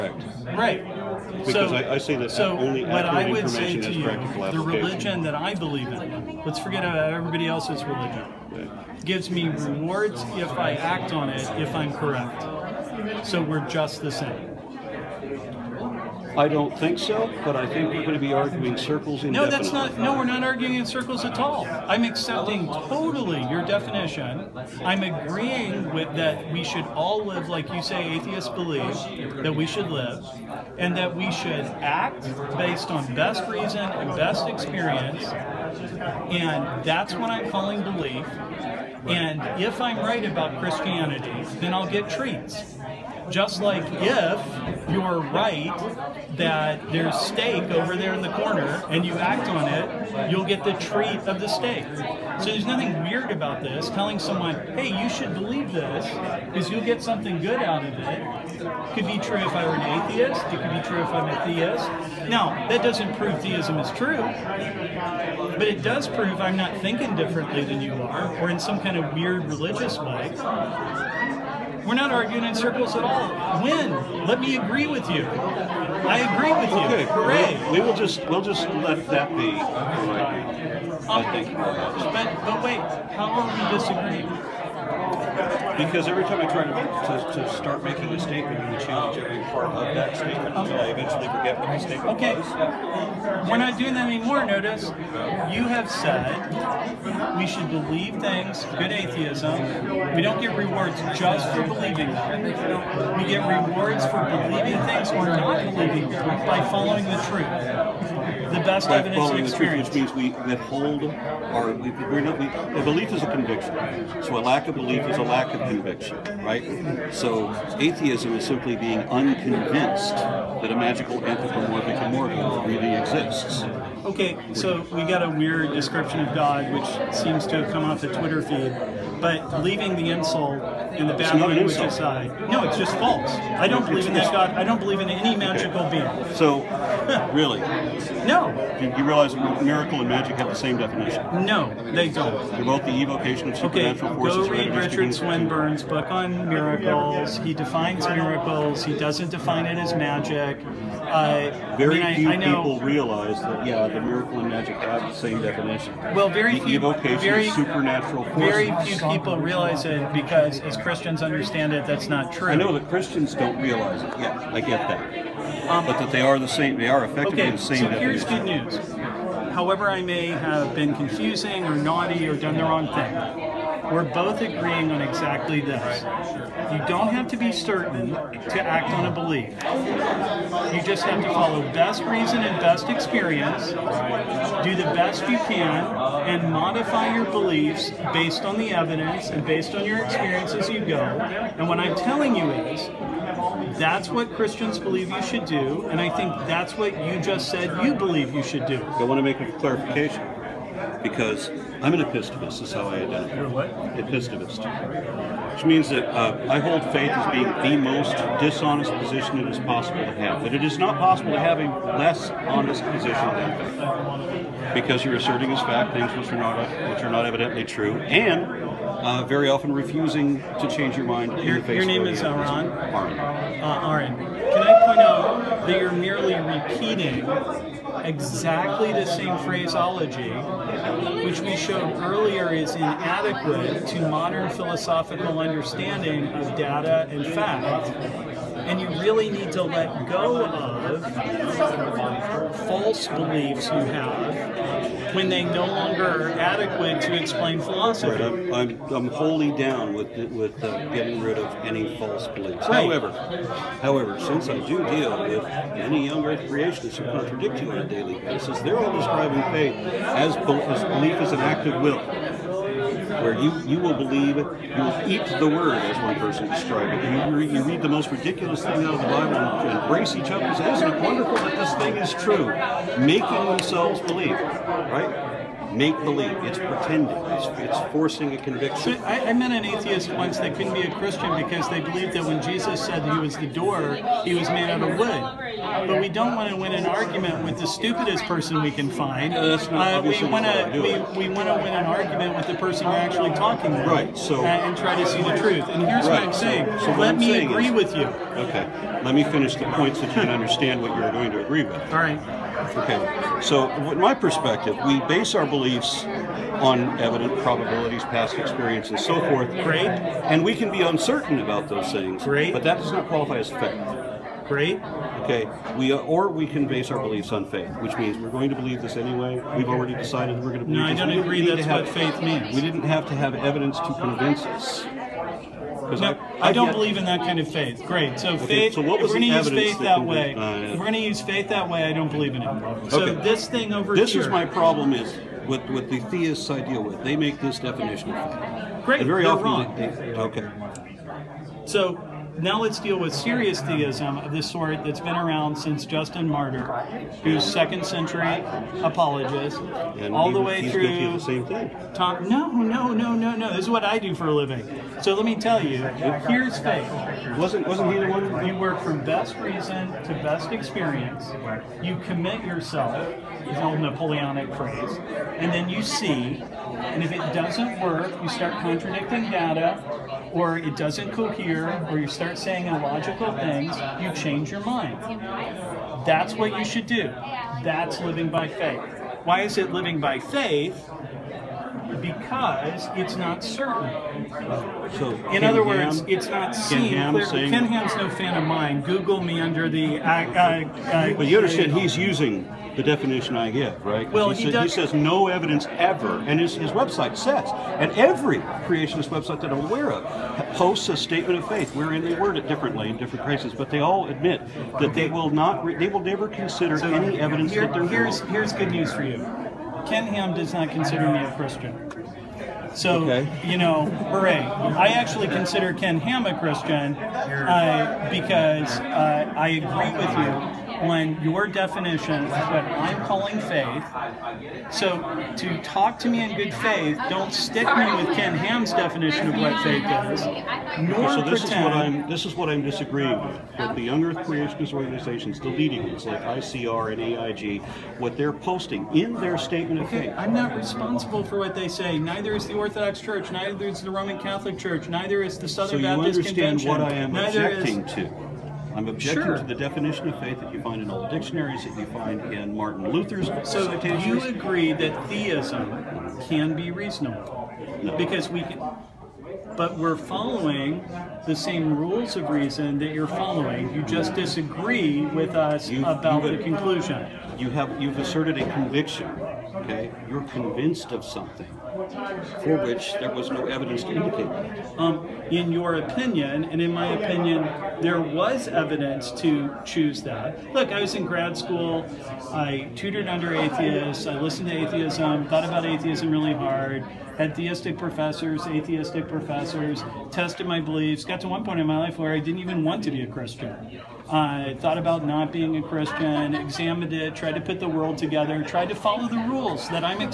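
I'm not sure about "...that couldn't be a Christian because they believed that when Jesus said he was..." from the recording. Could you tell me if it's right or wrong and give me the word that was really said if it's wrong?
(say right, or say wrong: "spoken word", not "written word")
right.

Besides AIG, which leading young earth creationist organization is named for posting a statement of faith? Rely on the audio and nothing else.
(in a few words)
ICR.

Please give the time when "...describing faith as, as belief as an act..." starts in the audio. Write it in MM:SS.
04:18.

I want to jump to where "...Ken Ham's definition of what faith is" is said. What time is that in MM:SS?
07:08.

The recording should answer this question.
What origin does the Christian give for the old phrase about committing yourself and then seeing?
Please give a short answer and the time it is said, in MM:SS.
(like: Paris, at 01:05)
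Napoleonic, at 06:03.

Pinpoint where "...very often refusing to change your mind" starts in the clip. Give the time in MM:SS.
03:39.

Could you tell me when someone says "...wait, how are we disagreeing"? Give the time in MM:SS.
01:22.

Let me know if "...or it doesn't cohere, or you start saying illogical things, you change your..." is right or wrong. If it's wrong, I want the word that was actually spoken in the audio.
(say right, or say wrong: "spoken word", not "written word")
right.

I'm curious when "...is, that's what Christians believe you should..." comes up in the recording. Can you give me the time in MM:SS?
03:12.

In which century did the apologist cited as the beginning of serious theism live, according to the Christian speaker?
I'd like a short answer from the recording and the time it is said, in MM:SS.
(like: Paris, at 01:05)
Second century, at 05:47.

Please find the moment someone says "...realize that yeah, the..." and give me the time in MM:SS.
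02:32.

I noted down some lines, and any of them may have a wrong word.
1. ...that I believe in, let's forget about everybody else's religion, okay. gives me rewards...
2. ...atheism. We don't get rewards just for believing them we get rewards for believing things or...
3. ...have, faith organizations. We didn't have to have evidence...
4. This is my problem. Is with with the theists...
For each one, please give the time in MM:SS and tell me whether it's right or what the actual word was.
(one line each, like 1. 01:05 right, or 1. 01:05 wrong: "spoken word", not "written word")
1. 00:05 right
2. 01:38 right
3. 05:21 wrong: "means", not "organizations"
4. 05:34 right.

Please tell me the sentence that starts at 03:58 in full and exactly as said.
And you really need to let go of false beliefs you have when they no longer are adequate to explain philosophy.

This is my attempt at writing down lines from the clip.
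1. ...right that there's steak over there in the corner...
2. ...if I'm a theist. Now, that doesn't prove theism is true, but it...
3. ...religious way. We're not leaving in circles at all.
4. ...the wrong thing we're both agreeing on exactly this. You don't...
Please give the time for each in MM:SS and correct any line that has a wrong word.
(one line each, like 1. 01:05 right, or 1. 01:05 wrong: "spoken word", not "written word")
1. 00:45 right
2. 01:01 right
3. 01:09 wrong: "arguing", not "leaving"
4. 02:52 right.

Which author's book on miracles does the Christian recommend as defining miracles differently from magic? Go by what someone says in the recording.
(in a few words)
Richard Swinburne.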